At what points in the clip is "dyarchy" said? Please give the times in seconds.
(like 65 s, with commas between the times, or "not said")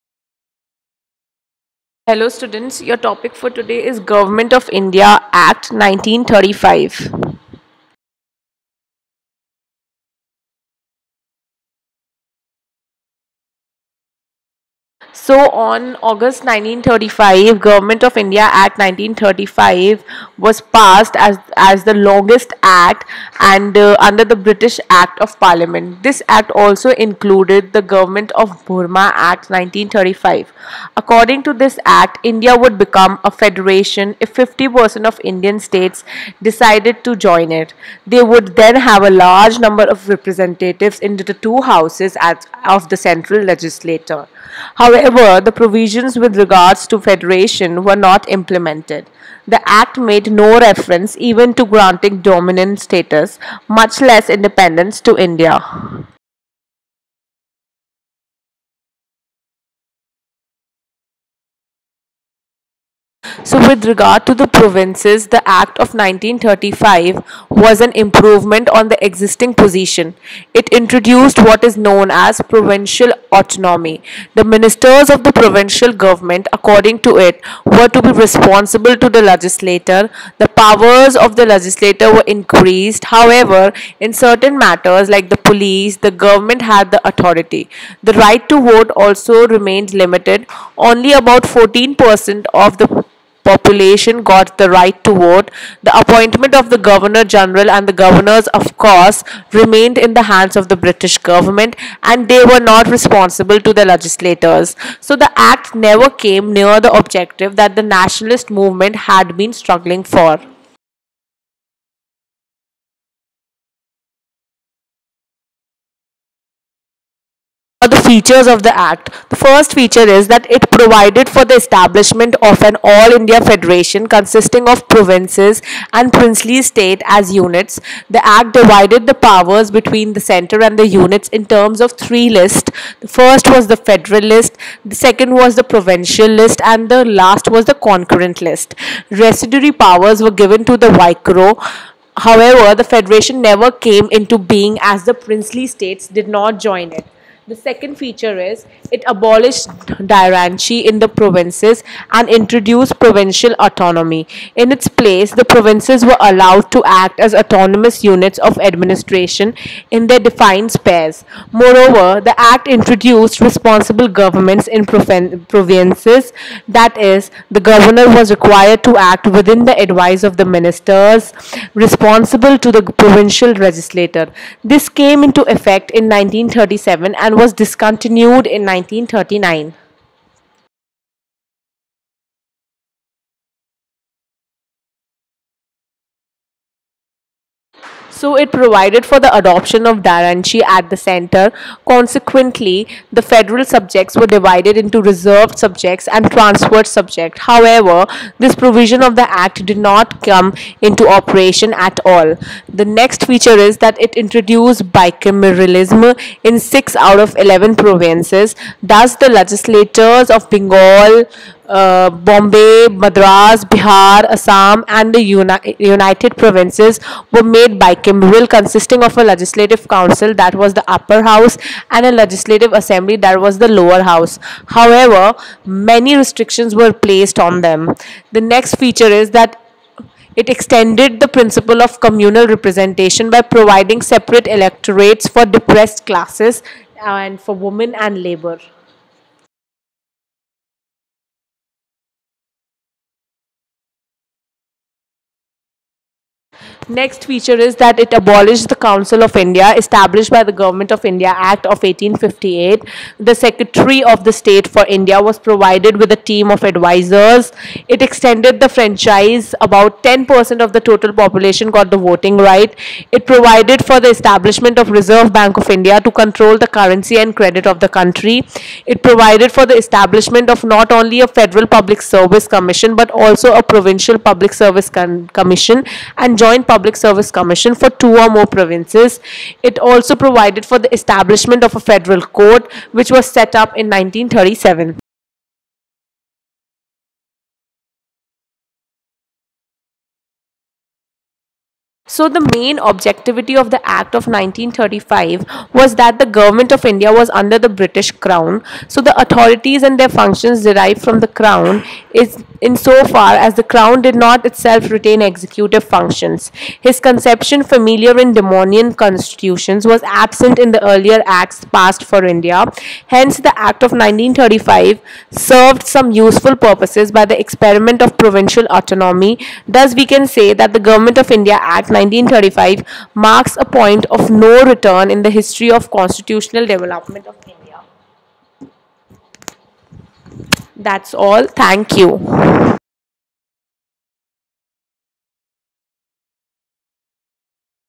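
150 s, 190 s.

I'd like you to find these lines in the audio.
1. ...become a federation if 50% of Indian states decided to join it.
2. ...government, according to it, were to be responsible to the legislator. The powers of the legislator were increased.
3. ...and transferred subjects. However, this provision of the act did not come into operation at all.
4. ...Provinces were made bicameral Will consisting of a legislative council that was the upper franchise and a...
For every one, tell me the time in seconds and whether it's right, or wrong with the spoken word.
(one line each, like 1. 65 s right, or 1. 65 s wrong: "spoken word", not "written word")
1. 32 s right
2. 75 s right
3. 196 s right
4. 216 s wrong: "house", not "franchise".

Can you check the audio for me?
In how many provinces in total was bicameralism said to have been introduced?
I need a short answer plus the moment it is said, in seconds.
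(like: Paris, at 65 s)
6, at 206 s.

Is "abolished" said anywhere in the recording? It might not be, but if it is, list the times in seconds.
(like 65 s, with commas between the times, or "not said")
149 s, 248 s.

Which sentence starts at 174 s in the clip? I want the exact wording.
This came into effect in 1937 and was discontinued in 1939.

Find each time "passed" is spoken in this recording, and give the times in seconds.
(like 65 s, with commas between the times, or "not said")
20 s, 311 s.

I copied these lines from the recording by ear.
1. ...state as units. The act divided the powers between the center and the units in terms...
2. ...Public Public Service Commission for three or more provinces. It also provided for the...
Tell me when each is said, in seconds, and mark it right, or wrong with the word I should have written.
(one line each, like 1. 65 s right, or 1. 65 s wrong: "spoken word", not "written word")
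1. 126 s right
2. 276 s wrong: "two", not "three".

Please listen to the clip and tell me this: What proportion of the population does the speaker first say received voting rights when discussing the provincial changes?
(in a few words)
14%.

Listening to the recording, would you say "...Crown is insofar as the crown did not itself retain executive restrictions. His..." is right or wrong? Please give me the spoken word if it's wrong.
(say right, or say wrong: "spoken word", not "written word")
wrong: "functions", not "restrictions".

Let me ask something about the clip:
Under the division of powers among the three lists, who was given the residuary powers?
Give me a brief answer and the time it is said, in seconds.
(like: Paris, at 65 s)
The Viceroy, at 140 s.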